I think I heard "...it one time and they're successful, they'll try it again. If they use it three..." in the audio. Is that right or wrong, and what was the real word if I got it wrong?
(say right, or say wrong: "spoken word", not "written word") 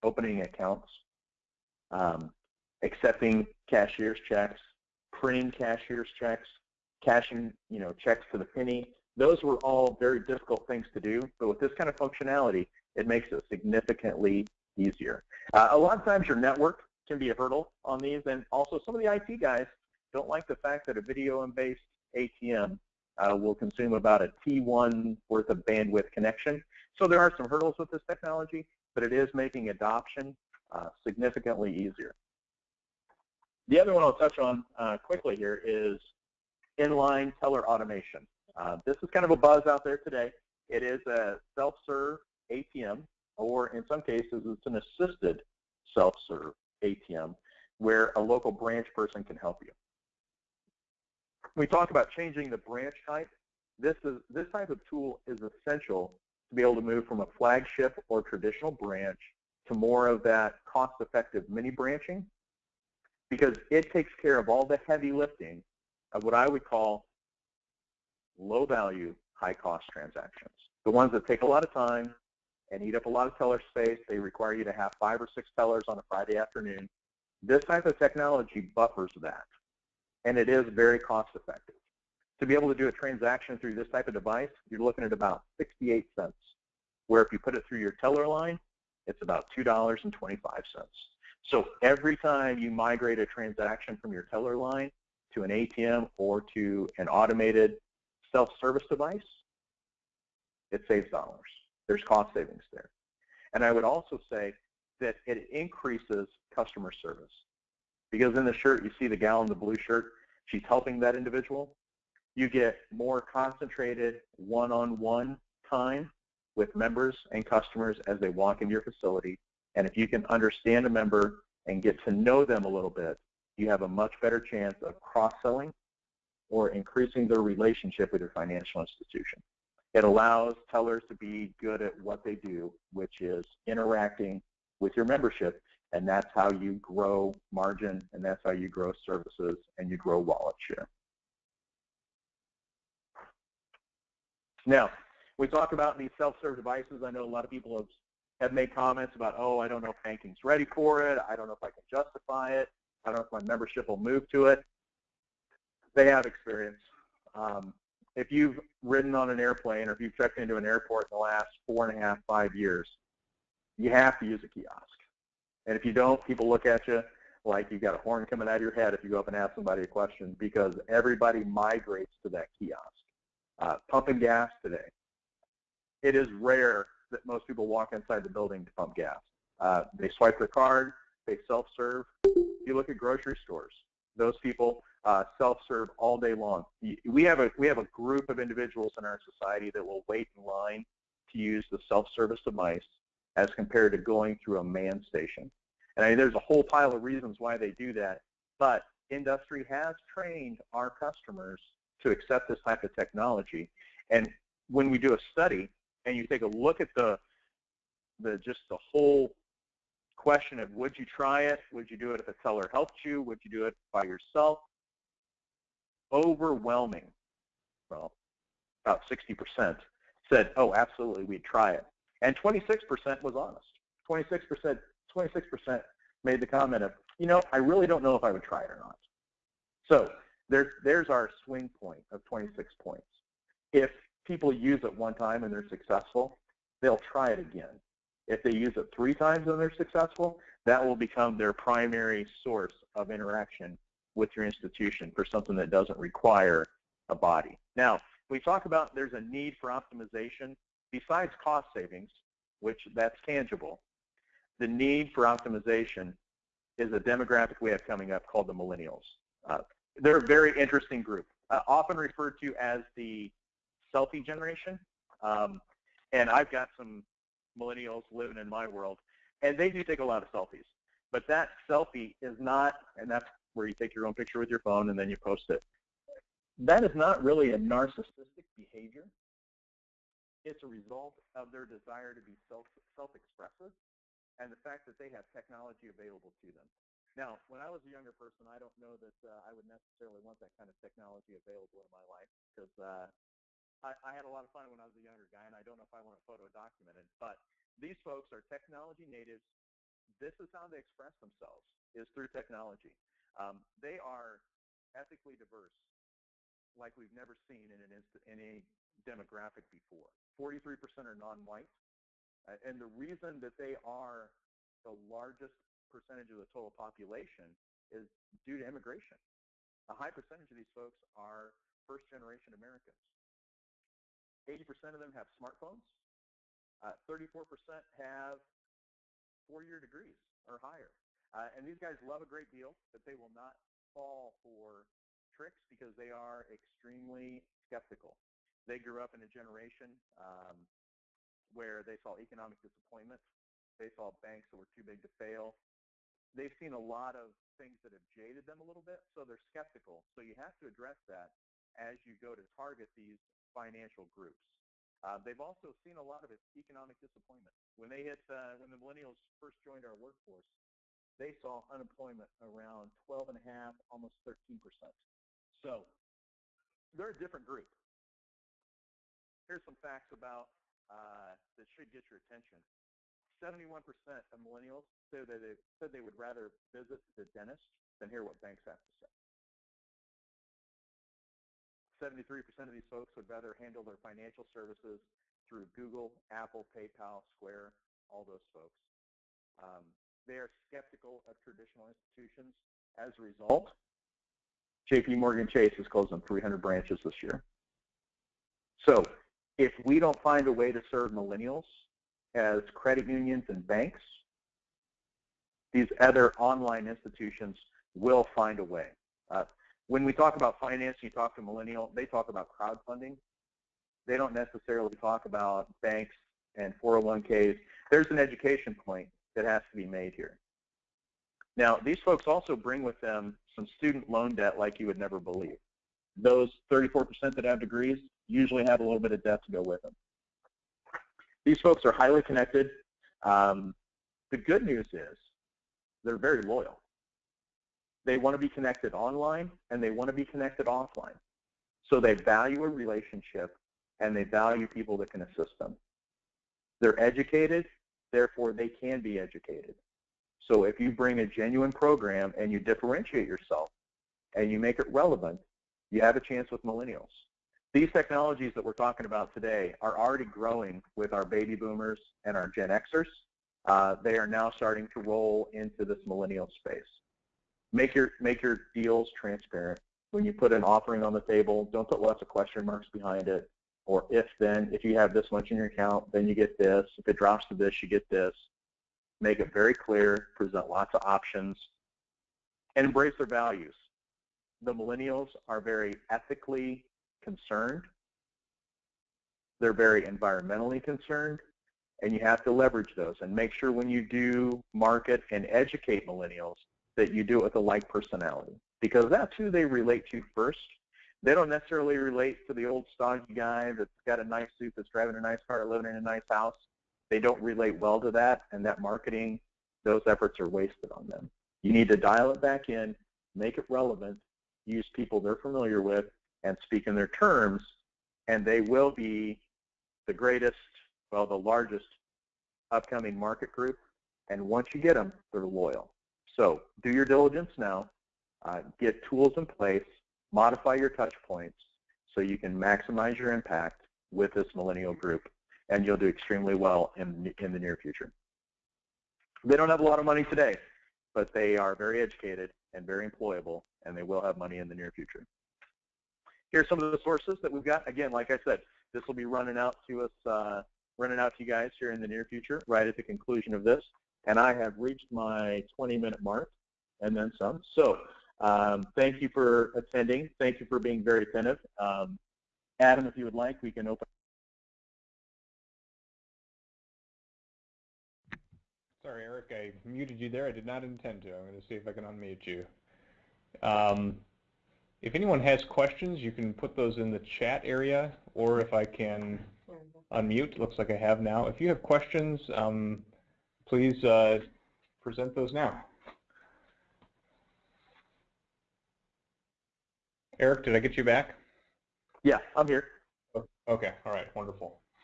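right.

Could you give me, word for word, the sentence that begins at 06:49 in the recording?
Uh, when we talk about finance, you talk to millennial, they talk about crowdfunding.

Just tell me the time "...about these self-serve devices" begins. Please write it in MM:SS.
02:25.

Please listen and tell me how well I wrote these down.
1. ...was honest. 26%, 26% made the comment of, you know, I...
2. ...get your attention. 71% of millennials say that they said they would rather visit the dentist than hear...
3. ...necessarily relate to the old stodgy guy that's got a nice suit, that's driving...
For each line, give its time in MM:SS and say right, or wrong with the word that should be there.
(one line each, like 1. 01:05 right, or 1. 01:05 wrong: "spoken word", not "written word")
1. 03:43 right
2. 06:11 right
3. 08:21 right.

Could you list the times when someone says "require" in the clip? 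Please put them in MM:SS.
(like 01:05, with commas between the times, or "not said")
01:14, 04:05.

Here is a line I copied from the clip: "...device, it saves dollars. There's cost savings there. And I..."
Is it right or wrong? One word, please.
right.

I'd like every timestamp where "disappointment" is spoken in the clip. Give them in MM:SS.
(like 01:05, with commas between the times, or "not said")
05:42, 05:56.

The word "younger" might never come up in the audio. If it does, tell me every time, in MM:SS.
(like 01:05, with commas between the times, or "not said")
04:47, 04:55.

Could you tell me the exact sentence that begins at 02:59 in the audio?
Uh, they swipe their card, they self-serve.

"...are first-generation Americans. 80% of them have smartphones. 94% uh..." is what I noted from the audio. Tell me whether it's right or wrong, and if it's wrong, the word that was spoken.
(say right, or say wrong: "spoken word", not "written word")
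wrong: "34", not "94".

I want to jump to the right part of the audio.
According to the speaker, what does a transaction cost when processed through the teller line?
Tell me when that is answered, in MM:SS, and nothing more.
01:29.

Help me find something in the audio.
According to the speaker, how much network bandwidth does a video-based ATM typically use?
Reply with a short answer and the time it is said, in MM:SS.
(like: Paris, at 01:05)
a T1, at 00:24.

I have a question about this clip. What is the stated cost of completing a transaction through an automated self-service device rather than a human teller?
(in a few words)
68 cents.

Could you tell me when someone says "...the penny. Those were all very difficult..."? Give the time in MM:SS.
00:08.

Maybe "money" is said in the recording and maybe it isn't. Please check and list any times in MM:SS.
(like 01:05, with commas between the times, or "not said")
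09:00, 09:04.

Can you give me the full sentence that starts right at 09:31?
I'm going to see if I can unmute you.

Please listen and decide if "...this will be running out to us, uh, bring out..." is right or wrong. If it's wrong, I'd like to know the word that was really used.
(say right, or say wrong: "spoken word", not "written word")
wrong: "running", not "bring".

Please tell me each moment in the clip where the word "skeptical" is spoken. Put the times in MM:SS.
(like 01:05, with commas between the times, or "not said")
05:37, 05:49, 06:30.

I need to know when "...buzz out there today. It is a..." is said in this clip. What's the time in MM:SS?
00:39.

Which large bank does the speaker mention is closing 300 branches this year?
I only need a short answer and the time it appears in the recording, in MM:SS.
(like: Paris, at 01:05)
JP Morgan Chase, at 06:34.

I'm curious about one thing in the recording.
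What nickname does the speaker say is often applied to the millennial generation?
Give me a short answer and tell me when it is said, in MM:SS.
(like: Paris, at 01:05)
the selfie generation, at 04:22.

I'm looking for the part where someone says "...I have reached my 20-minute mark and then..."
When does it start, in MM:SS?
09:14.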